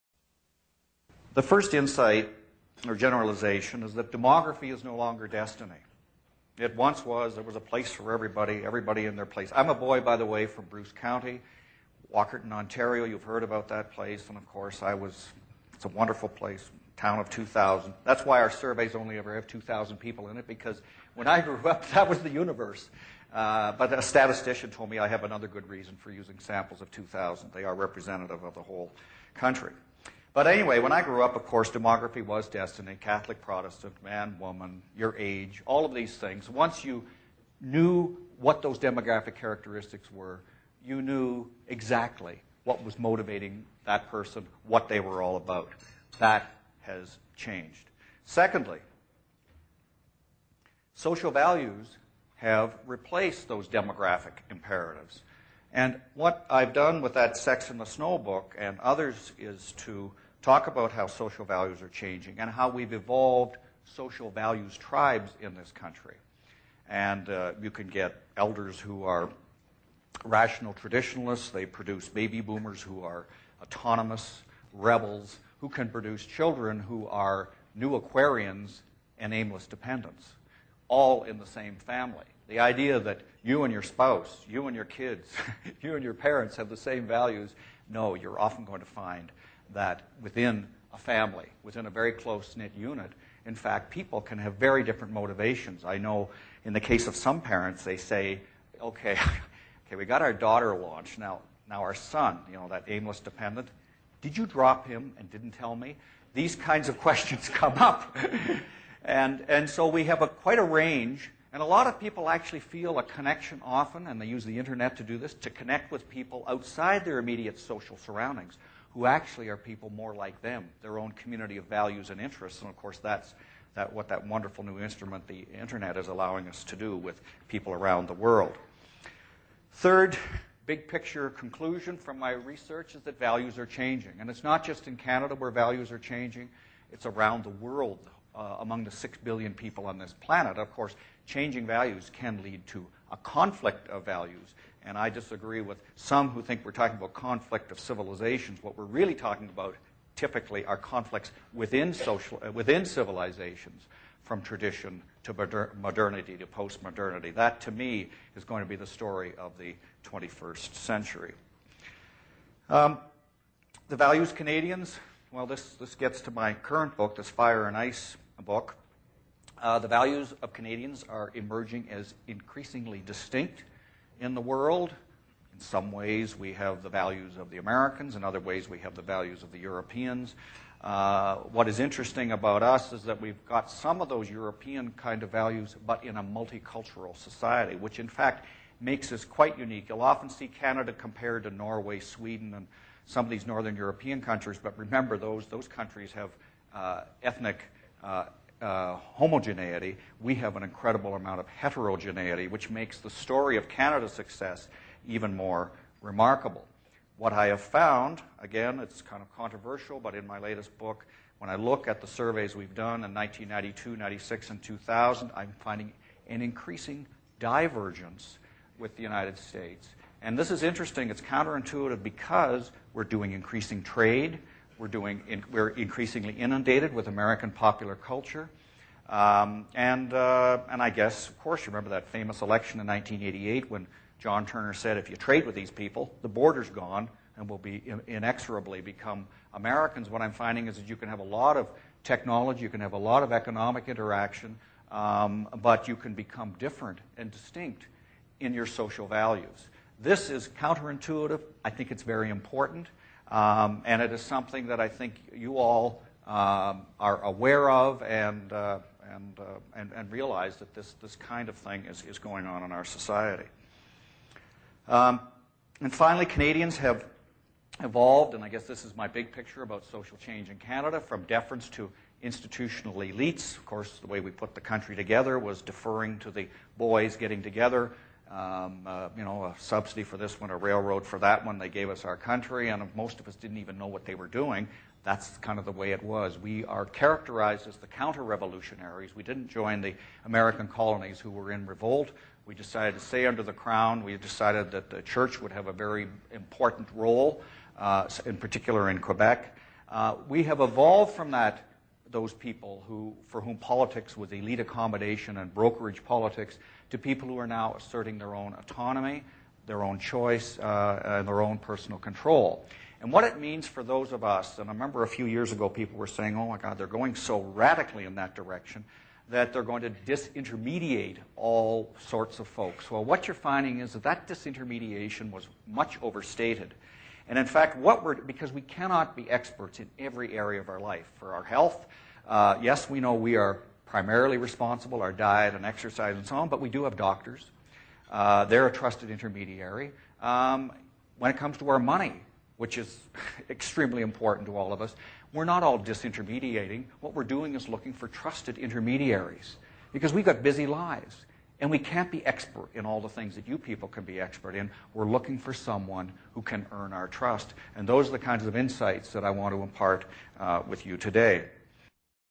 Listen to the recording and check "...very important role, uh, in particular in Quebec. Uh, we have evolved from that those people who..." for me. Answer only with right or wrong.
right.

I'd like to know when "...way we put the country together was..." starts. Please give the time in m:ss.
4:34.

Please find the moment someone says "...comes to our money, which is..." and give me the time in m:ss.
5:41.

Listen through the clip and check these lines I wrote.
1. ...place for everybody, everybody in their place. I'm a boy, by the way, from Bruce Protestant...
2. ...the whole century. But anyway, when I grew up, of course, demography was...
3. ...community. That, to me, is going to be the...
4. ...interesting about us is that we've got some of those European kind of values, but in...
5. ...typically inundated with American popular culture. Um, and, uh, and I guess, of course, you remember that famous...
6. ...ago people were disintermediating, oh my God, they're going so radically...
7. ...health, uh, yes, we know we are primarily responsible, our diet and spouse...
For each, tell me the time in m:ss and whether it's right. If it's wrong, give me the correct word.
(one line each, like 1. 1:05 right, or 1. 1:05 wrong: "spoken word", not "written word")
1. 0:07 wrong: "County", not "Protestant"
2. 0:28 wrong: "country", not "century"
3. 2:36 wrong: "postmodernity", not "community"
4. 3:01 right
5. 3:45 wrong: "increasingly", not "typically"
6. 5:15 wrong: "saying", not "disintermediating"
7. 5:31 wrong: "exercise", not "spouse".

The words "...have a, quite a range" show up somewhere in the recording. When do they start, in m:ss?
1:50.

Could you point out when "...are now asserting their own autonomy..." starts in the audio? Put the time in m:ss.
5:07.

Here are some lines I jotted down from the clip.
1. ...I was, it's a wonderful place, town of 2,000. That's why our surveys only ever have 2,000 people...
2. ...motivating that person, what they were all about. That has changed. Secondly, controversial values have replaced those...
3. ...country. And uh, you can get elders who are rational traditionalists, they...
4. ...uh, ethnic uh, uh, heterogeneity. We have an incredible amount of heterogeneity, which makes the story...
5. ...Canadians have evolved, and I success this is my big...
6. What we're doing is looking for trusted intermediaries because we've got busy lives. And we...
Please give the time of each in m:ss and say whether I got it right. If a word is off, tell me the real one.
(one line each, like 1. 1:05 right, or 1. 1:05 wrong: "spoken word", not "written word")
1. 0:14 right
2. 0:42 wrong: "social", not "controversial"
3. 1:05 right
4. 3:16 wrong: "homogeneity", not "heterogeneity"
5. 4:26 wrong: "guess", not "success"
6. 5:46 right.